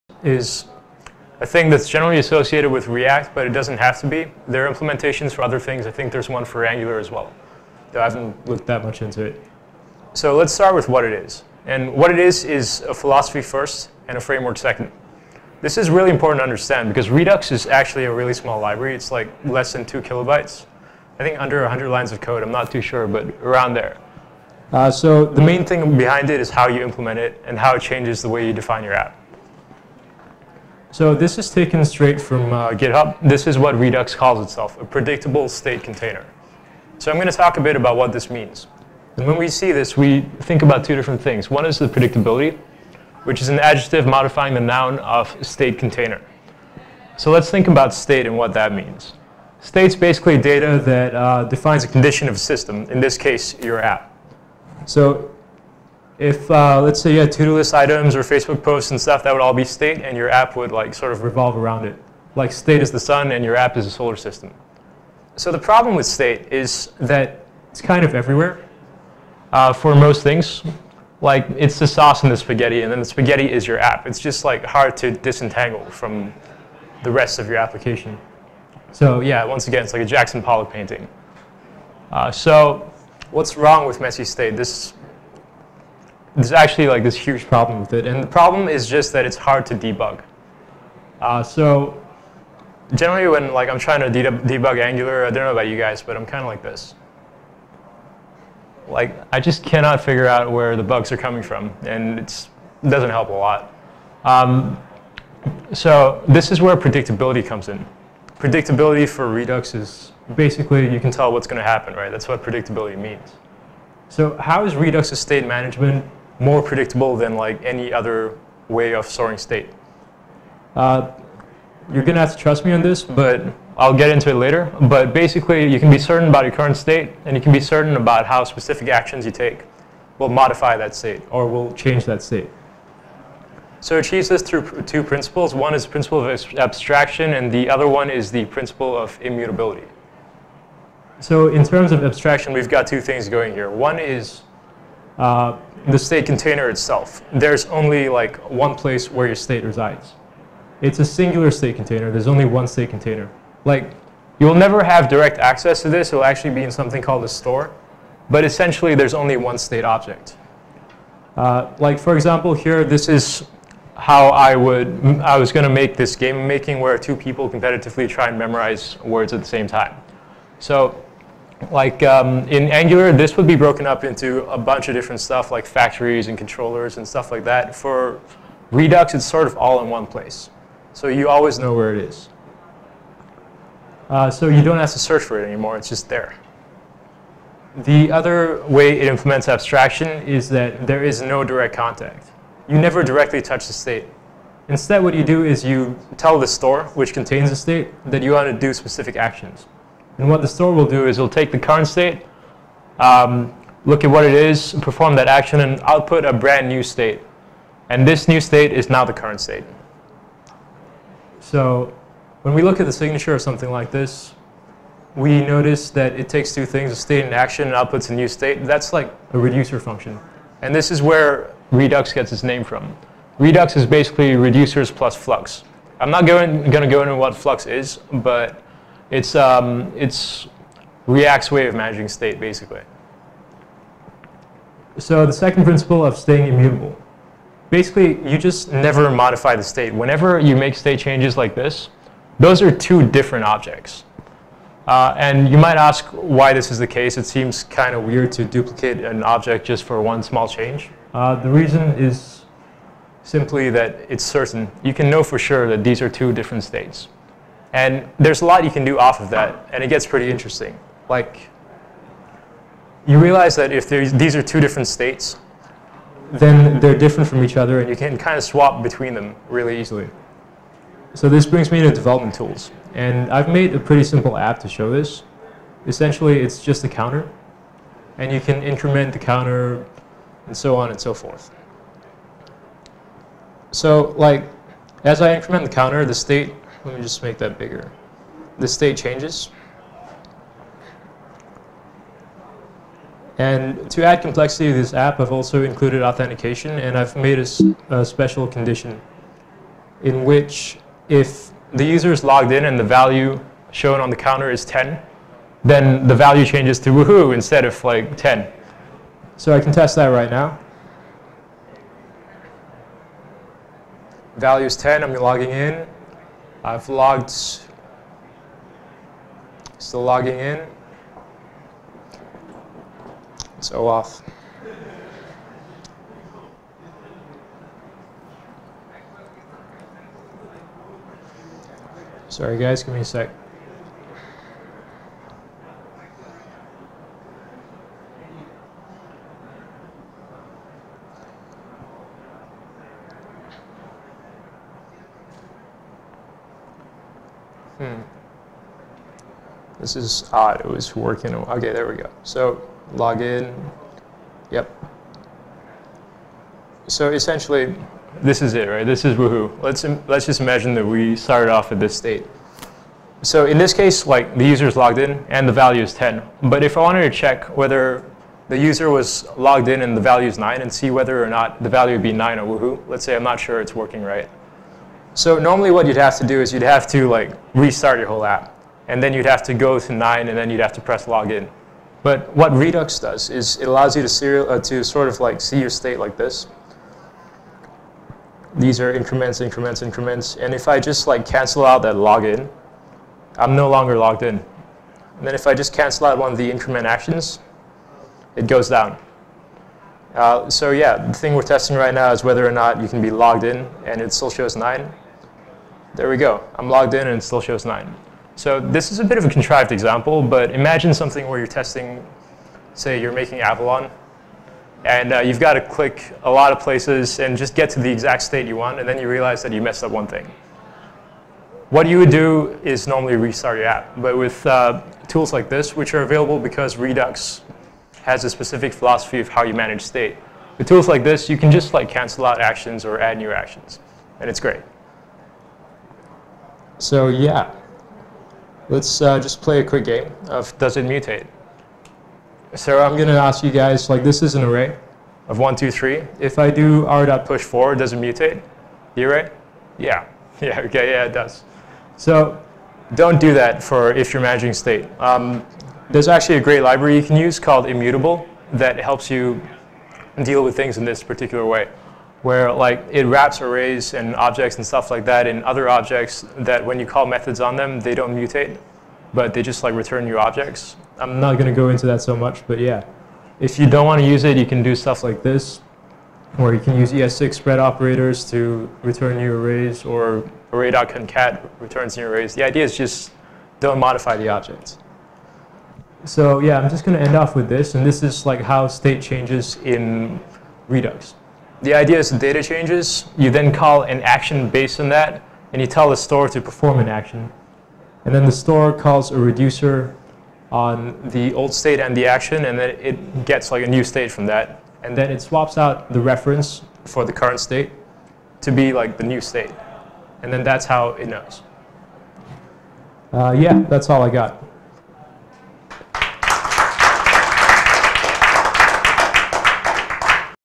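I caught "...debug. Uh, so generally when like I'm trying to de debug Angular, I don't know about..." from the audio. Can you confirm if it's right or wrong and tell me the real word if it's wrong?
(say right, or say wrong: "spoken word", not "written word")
right.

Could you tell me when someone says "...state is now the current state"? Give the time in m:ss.
3:28.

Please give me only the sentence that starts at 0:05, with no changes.
I think there's one for Angular as well, though I haven't looked that much into it.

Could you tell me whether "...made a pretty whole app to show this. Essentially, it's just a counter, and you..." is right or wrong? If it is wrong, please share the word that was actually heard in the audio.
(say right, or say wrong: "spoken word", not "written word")
wrong: "simple", not "whole".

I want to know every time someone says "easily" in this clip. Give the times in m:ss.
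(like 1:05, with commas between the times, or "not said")
4:29.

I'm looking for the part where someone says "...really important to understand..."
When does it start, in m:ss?
0:15.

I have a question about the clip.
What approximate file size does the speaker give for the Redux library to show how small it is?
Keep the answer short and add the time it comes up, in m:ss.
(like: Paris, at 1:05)
Less than 2 kilobytes, at 0:19.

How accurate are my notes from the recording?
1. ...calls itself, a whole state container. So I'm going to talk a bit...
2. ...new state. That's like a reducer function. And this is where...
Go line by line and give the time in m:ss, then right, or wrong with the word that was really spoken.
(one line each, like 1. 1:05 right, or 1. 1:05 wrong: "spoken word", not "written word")
1. 0:34 wrong: "predictable", not "whole"
2. 3:38 right.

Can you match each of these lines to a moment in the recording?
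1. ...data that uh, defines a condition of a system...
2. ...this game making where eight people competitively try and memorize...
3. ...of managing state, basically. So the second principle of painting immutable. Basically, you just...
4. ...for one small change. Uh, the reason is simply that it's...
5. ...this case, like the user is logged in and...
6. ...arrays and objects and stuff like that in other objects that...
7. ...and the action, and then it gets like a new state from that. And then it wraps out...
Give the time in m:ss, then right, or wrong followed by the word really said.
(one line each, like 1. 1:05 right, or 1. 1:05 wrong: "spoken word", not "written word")
1. 0:50 right
2. 2:45 wrong: "two", not "eight"
3. 3:51 wrong: "staying", not "painting"
4. 4:09 right
5. 6:03 right
6. 7:43 right
7. 8:21 wrong: "swaps", not "wraps".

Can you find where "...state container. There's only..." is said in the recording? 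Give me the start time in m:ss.
2:31.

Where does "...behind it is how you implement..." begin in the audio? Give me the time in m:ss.
0:25.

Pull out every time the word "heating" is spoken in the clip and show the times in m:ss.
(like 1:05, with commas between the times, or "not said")
not said.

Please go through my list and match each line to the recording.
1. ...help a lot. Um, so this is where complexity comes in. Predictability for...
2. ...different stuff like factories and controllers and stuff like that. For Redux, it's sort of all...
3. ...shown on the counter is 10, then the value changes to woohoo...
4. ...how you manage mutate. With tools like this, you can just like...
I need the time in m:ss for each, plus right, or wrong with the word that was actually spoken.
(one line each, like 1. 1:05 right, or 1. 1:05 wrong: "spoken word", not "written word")
1. 1:43 wrong: "predictability", not "complexity"
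2. 2:54 right
3. 5:03 right
4. 7:09 wrong: "state", not "mutate".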